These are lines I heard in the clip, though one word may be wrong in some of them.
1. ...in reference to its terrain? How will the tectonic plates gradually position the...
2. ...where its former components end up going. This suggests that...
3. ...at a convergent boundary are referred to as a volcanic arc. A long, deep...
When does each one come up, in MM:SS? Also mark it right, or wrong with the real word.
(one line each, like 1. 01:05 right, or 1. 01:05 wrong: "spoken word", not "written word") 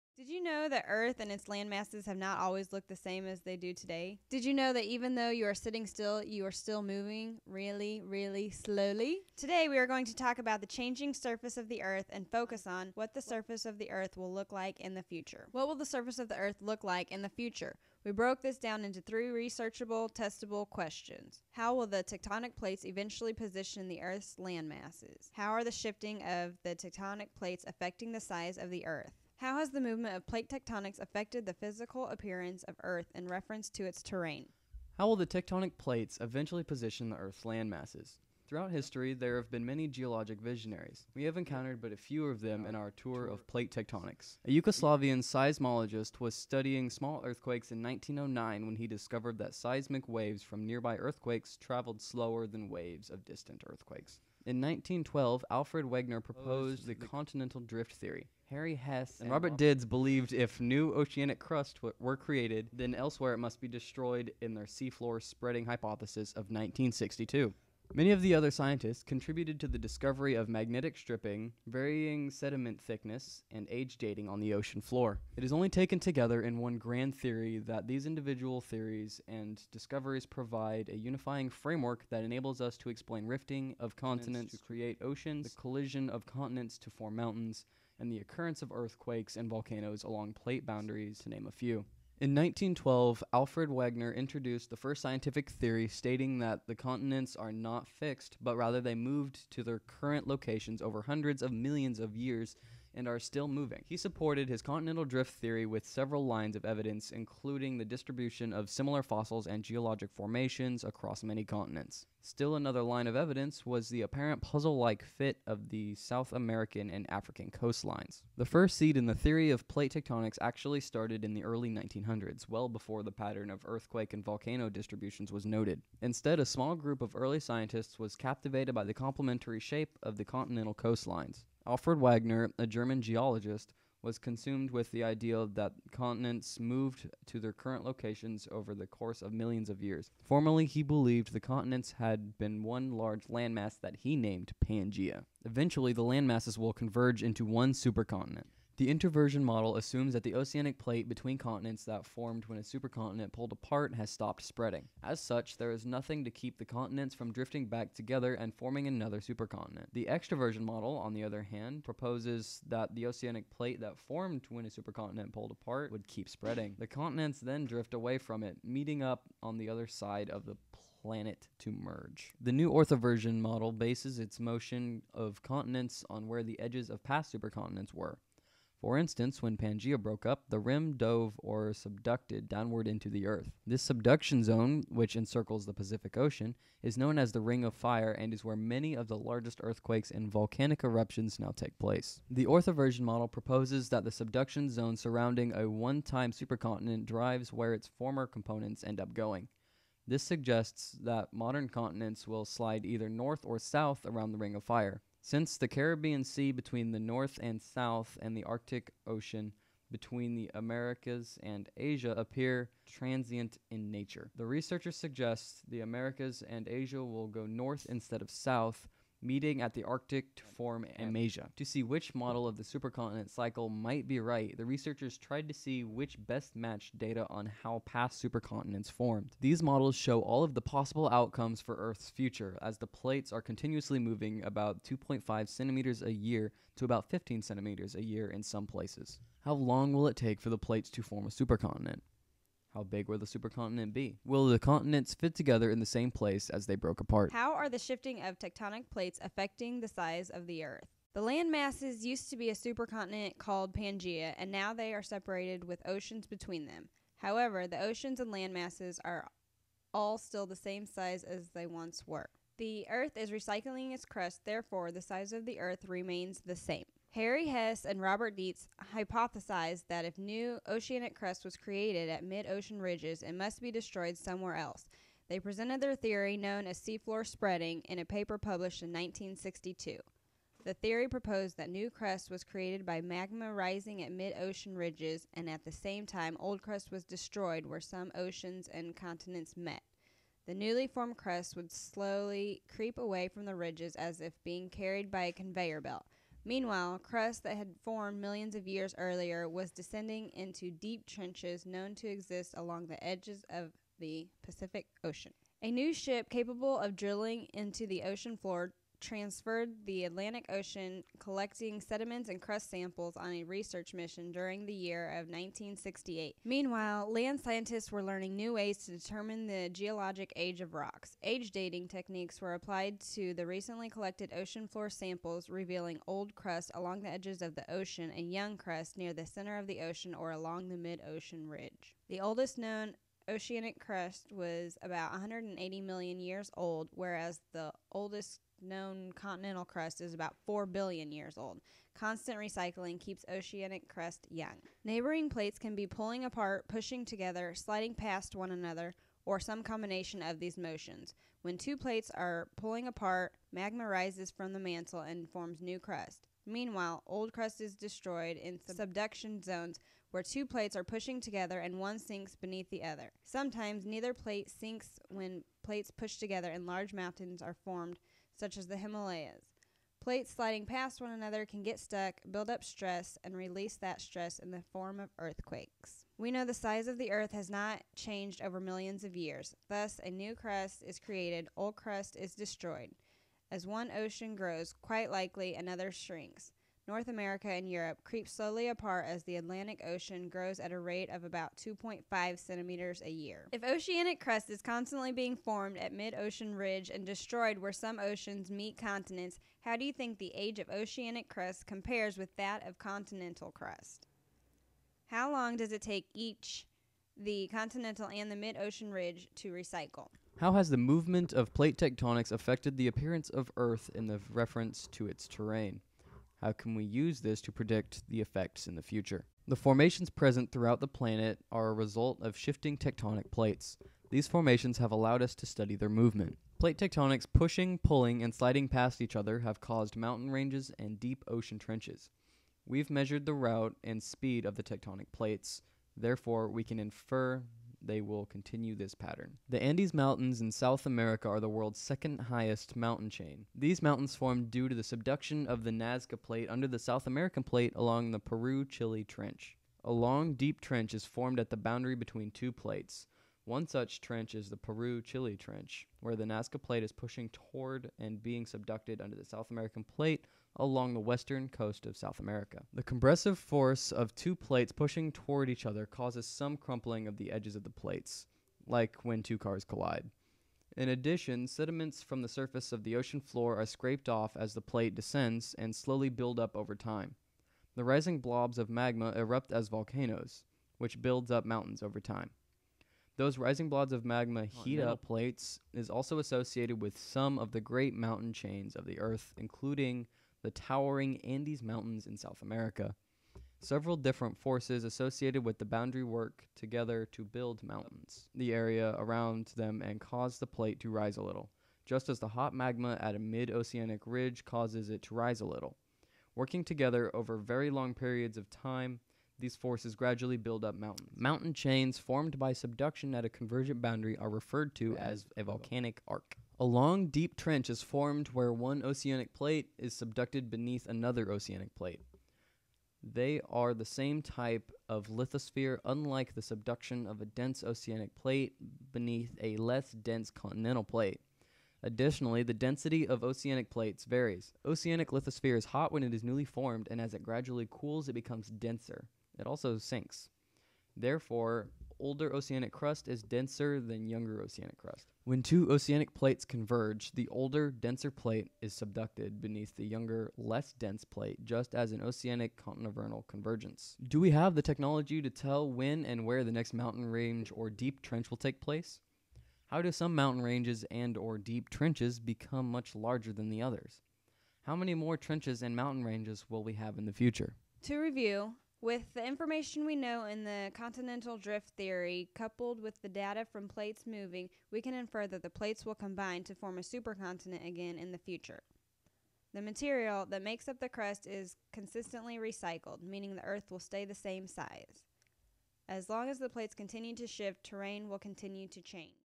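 1. 00:33 wrong: "eventually", not "gradually"
2. 03:17 right
3. 08:33 right.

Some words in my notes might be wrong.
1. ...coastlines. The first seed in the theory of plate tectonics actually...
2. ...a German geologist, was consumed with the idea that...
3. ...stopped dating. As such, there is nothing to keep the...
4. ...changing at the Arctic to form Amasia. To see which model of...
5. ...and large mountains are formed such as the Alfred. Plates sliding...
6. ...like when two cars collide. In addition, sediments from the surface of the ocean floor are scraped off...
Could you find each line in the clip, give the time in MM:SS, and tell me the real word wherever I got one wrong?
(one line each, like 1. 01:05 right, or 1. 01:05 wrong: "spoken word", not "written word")
1. 01:57 right
2. 02:12 right
3. 02:34 wrong: "spreading", not "dating"
4. 03:39 wrong: "meeting", not "changing"
5. 06:06 wrong: "Himalayas", not "Alfred"
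6. 07:48 right.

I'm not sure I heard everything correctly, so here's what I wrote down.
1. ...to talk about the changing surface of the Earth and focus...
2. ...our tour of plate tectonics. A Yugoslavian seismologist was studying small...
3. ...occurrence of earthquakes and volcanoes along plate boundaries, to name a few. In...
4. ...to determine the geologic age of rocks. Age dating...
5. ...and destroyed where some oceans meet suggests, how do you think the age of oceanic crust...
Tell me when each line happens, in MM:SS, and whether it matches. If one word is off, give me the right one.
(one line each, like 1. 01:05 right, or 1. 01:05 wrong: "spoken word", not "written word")
1. 00:10 right
2. 00:42 right
3. 01:28 right
4. 05:18 right
5. 06:36 wrong: "continents", not "suggests".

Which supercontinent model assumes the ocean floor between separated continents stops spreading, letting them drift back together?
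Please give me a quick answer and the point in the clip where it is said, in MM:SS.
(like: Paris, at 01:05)
introversion model, at 02:28.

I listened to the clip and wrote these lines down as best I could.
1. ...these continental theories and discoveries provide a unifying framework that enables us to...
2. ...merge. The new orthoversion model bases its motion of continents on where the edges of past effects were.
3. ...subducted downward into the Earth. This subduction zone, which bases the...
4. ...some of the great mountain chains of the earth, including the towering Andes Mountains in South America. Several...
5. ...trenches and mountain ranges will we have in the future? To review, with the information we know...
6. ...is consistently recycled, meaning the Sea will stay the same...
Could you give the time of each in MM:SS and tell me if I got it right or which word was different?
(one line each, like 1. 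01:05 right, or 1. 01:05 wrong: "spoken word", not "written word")
1. 01:17 wrong: "individual", not "continental"
2. 02:51 wrong: "supercontinents", not "effects"
3. 03:01 wrong: "encircles", not "bases"
4. 08:06 right
5. 09:25 right
6. 09:41 wrong: "Earth", not "Sea".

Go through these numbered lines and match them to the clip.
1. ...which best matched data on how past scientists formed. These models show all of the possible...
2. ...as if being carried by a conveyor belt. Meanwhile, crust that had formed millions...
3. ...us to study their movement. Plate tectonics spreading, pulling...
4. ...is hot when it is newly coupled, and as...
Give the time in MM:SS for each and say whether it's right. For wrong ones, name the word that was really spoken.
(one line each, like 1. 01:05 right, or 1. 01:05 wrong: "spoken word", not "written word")
1. 03:45 wrong: "supercontinents", not "scientists"
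2. 04:53 right
3. 07:05 wrong: "pushing", not "spreading"
4. 08:55 wrong: "formed", not "coupled".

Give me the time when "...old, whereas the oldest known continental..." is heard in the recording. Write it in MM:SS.
05:36.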